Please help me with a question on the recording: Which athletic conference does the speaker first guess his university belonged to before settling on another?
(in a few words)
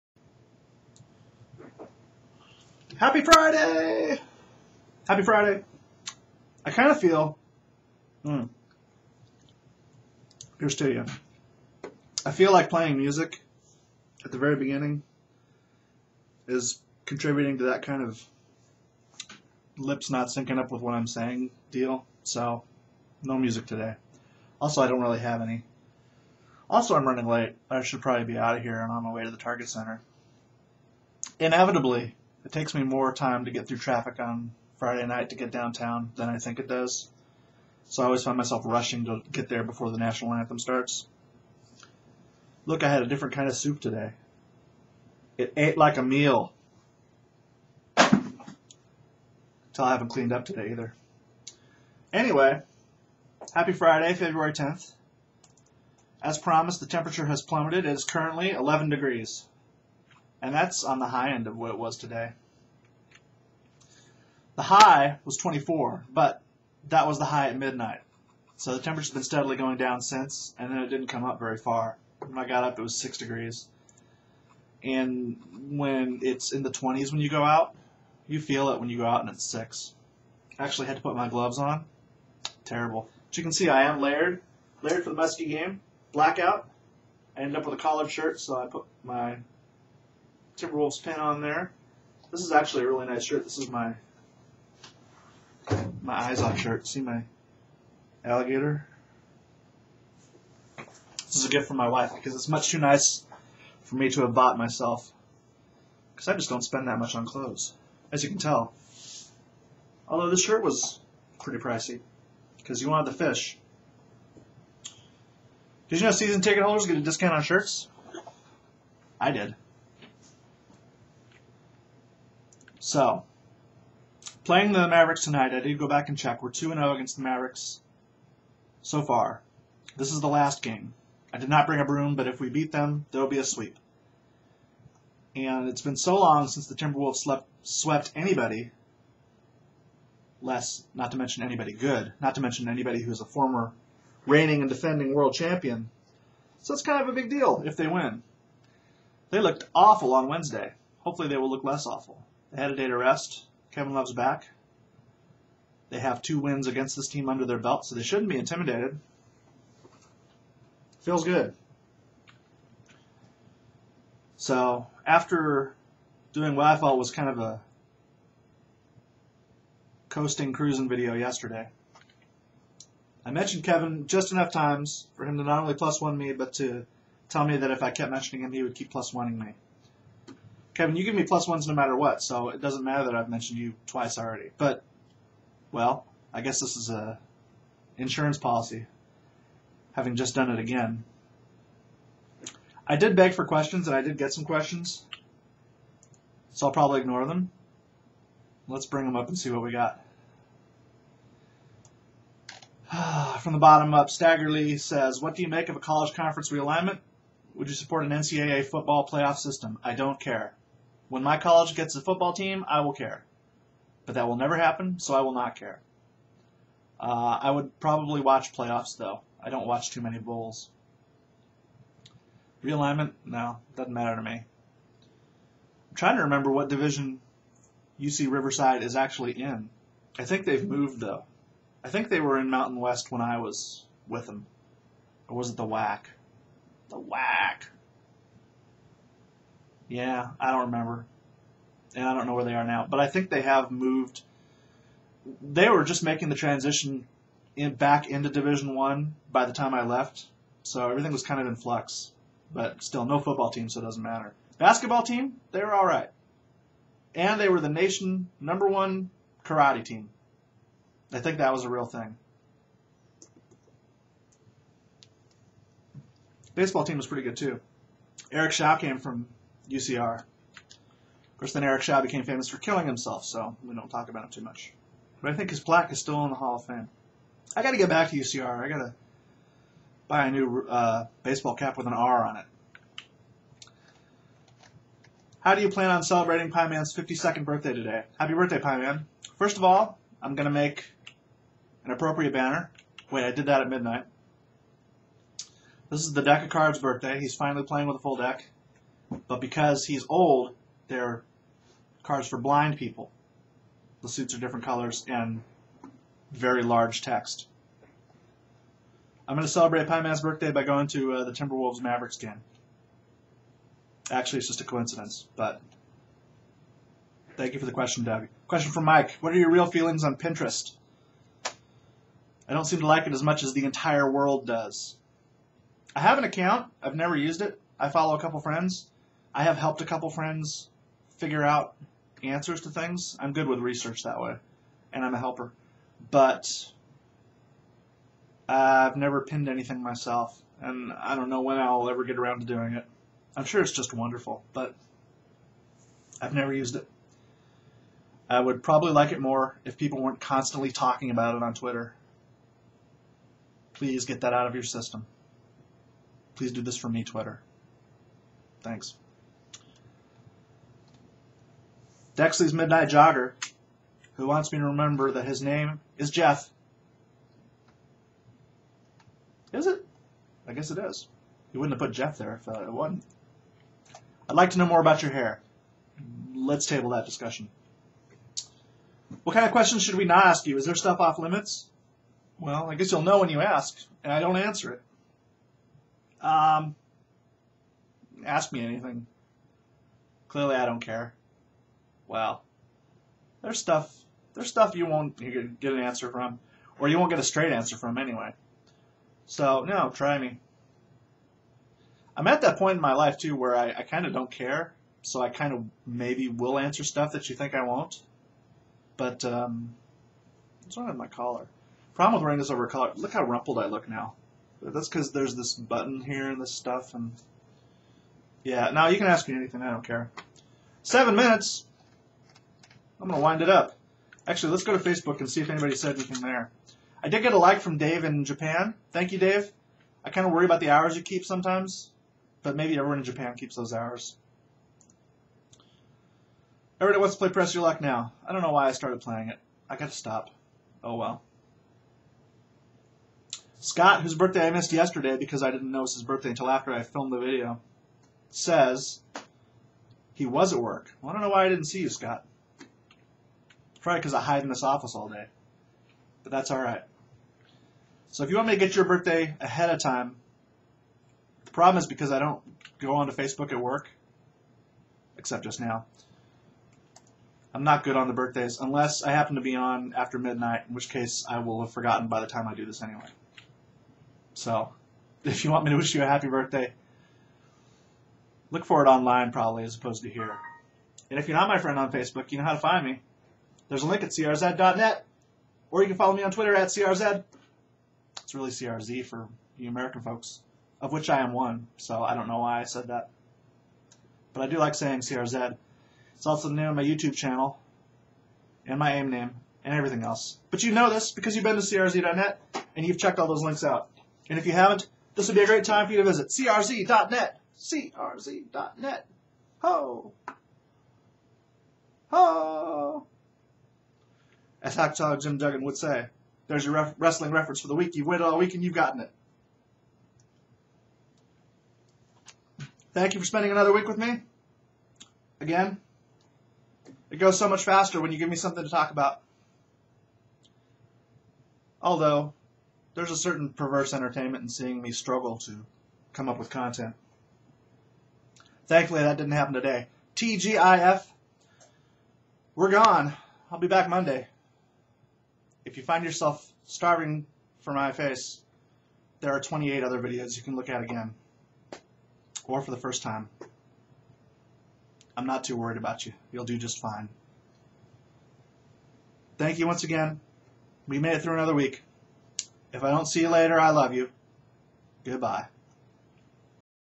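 Mountain West.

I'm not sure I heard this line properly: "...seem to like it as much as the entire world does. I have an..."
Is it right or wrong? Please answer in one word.
right.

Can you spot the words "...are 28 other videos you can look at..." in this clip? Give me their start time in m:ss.
9:09.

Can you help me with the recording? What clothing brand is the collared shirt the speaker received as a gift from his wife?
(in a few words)
Izod.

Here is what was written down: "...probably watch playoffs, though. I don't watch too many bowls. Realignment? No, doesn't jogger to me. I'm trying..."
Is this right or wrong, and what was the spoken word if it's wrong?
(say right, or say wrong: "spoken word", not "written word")
wrong: "matter", not "jogger".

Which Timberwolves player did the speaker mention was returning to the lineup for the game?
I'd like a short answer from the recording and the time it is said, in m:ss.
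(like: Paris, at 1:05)
Kevin Love, at 2:33.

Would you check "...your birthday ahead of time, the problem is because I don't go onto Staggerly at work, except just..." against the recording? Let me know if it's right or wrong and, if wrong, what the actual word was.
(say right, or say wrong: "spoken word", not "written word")
wrong: "Facebook", not "Staggerly".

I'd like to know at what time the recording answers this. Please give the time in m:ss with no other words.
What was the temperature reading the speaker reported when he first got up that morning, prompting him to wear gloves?
1:12.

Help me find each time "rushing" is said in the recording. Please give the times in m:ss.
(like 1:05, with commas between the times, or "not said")
0:38.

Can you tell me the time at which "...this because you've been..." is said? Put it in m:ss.
8:20.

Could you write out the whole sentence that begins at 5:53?
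Please get that out of your system.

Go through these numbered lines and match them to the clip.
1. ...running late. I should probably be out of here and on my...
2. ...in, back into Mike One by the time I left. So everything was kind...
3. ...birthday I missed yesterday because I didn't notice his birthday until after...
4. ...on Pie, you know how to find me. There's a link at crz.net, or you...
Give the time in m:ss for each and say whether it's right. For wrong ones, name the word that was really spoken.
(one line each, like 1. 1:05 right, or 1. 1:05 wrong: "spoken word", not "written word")
1. 0:27 right
2. 4:07 wrong: "Division", not "Mike"
3. 7:24 right
4. 8:01 wrong: "Facebook", not "Pie".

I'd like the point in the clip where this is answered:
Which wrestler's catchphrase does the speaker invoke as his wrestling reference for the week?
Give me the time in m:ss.
8:34.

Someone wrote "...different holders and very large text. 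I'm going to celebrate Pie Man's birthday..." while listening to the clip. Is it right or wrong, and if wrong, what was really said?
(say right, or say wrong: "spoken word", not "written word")
wrong: "colors", not "holders".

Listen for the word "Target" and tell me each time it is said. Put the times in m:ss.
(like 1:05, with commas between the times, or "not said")
0:29.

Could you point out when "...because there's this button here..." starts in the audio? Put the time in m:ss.
6:54.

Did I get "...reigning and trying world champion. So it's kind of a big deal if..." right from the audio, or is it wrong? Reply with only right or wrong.
wrong.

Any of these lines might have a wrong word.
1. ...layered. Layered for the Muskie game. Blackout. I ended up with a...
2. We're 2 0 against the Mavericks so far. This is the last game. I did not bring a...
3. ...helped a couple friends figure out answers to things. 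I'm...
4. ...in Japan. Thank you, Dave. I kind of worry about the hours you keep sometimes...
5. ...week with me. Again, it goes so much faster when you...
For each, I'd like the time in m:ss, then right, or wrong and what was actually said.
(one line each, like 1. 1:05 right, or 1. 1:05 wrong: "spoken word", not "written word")
1. 1:24 right
2. 2:06 right
3. 5:29 right
4. 7:08 right
5. 8:43 right.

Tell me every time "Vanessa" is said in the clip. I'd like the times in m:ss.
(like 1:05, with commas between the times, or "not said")
not said.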